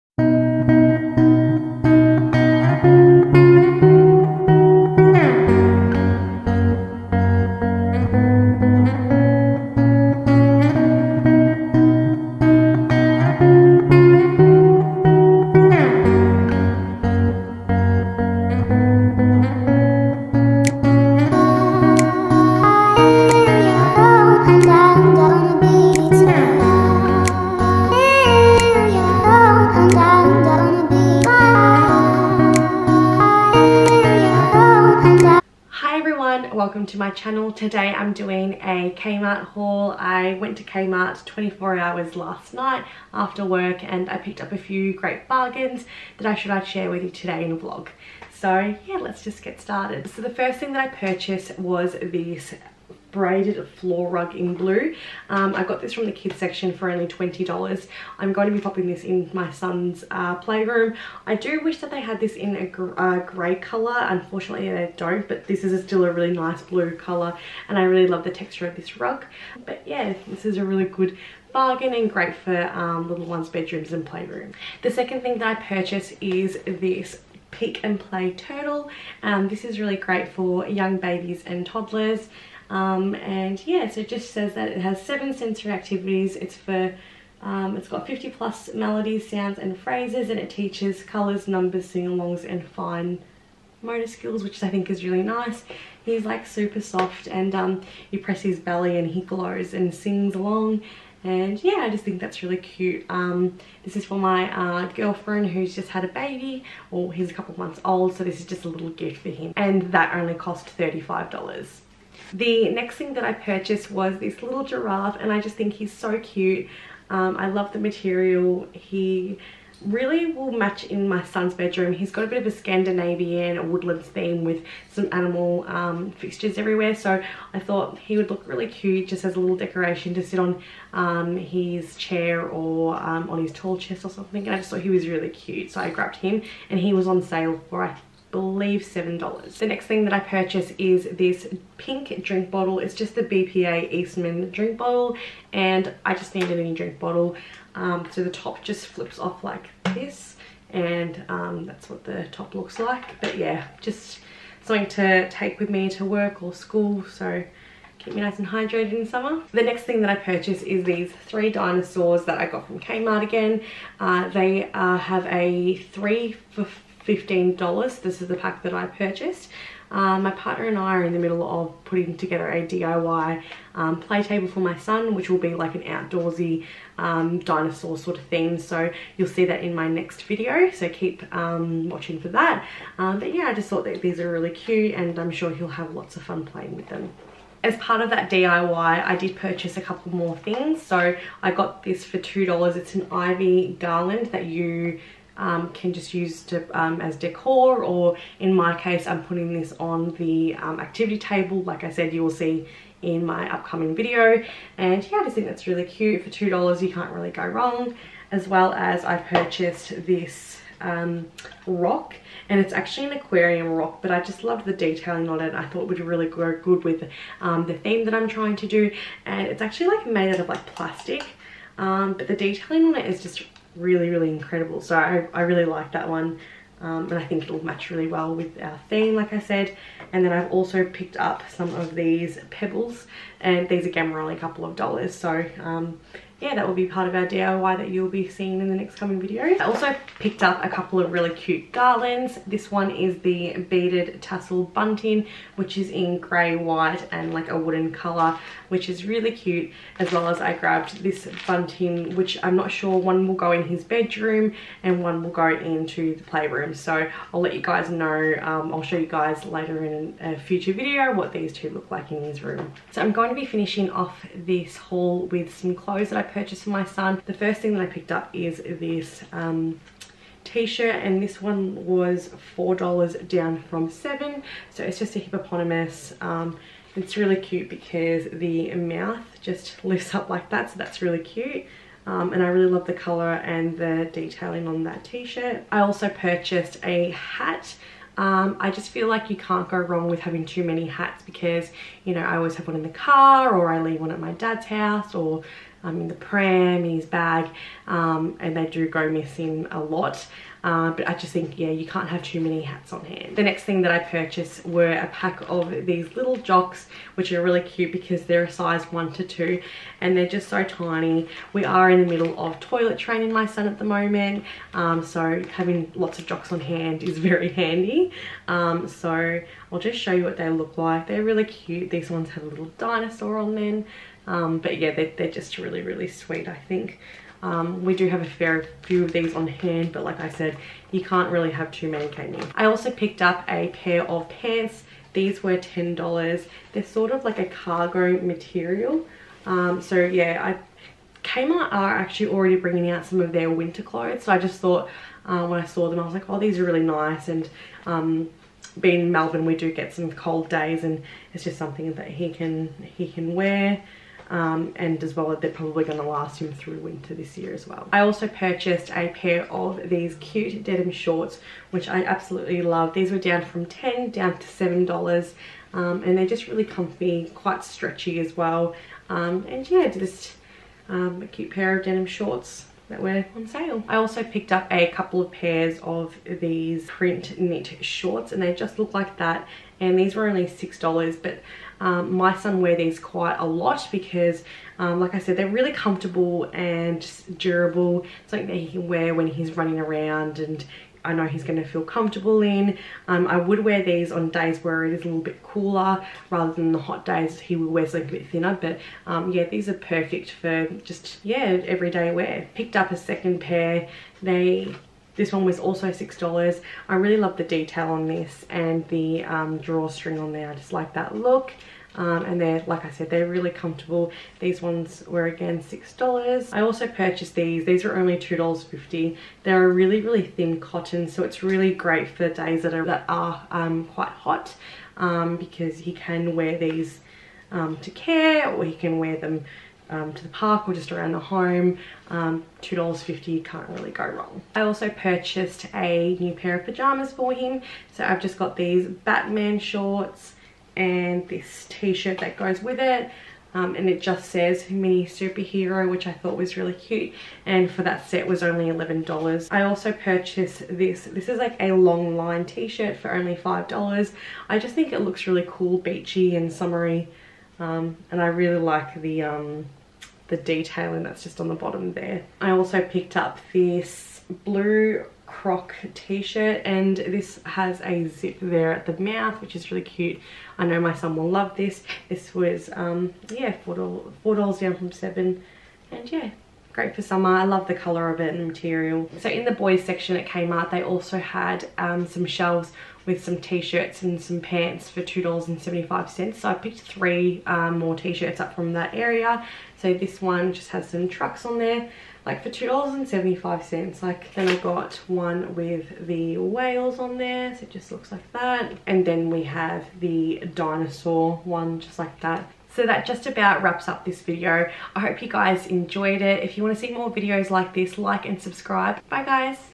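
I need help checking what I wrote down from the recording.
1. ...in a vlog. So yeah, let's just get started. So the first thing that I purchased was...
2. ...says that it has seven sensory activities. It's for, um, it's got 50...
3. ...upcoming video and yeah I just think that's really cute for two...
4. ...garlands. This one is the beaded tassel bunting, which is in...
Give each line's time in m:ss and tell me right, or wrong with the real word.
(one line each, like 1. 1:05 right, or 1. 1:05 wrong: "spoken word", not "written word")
1. 0:47 right
2. 1:24 right
3. 3:23 right
4. 4:01 right.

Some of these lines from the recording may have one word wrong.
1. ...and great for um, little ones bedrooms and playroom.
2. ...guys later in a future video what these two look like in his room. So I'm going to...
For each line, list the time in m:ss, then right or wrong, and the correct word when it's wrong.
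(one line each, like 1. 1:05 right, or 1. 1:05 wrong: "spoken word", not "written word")
1. 1:11 right
2. 4:19 right.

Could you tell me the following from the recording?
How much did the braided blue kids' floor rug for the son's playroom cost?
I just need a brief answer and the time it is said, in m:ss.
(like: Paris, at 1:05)
$20, at 0:57.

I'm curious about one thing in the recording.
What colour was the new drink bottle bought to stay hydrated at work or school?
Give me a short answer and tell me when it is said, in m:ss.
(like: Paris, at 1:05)
Pink, at 2:21.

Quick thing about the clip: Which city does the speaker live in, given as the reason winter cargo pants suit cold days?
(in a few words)
Melbourne.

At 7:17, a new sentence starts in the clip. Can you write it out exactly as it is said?
So I've just got these Batman shorts and this t-shirt that goes with it.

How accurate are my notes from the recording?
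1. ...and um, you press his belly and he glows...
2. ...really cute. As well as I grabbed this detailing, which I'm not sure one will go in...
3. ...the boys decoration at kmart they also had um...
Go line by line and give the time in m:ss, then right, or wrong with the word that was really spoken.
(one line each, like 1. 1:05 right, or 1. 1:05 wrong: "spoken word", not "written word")
1. 1:37 right
2. 4:09 wrong: "bunting", not "detailing"
3. 7:59 wrong: "section", not "decoration".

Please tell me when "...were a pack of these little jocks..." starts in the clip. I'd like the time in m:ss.
5:04.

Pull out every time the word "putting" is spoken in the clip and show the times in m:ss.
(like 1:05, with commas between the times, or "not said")
2:51, 3:19.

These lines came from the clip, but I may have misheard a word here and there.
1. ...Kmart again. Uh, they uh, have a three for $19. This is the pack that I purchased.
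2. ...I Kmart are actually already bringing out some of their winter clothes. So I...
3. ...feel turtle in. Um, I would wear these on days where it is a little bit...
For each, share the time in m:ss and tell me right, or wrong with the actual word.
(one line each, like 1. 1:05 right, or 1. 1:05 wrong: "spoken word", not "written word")
1. 2:42 wrong: "15", not "19"
2. 5:40 right
3. 6:31 wrong: "comfortable", not "turtle".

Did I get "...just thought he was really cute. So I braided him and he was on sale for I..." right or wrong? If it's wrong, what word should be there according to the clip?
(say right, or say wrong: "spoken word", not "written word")
wrong: "grabbed", not "braided".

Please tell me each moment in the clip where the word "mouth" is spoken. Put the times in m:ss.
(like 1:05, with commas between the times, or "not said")
4:38, 7:49.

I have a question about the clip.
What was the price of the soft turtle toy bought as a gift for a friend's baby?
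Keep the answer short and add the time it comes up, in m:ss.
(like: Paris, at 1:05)
$35, at 1:50.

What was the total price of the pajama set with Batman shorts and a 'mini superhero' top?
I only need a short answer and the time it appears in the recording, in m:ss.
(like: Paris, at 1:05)
$11, at 7:28.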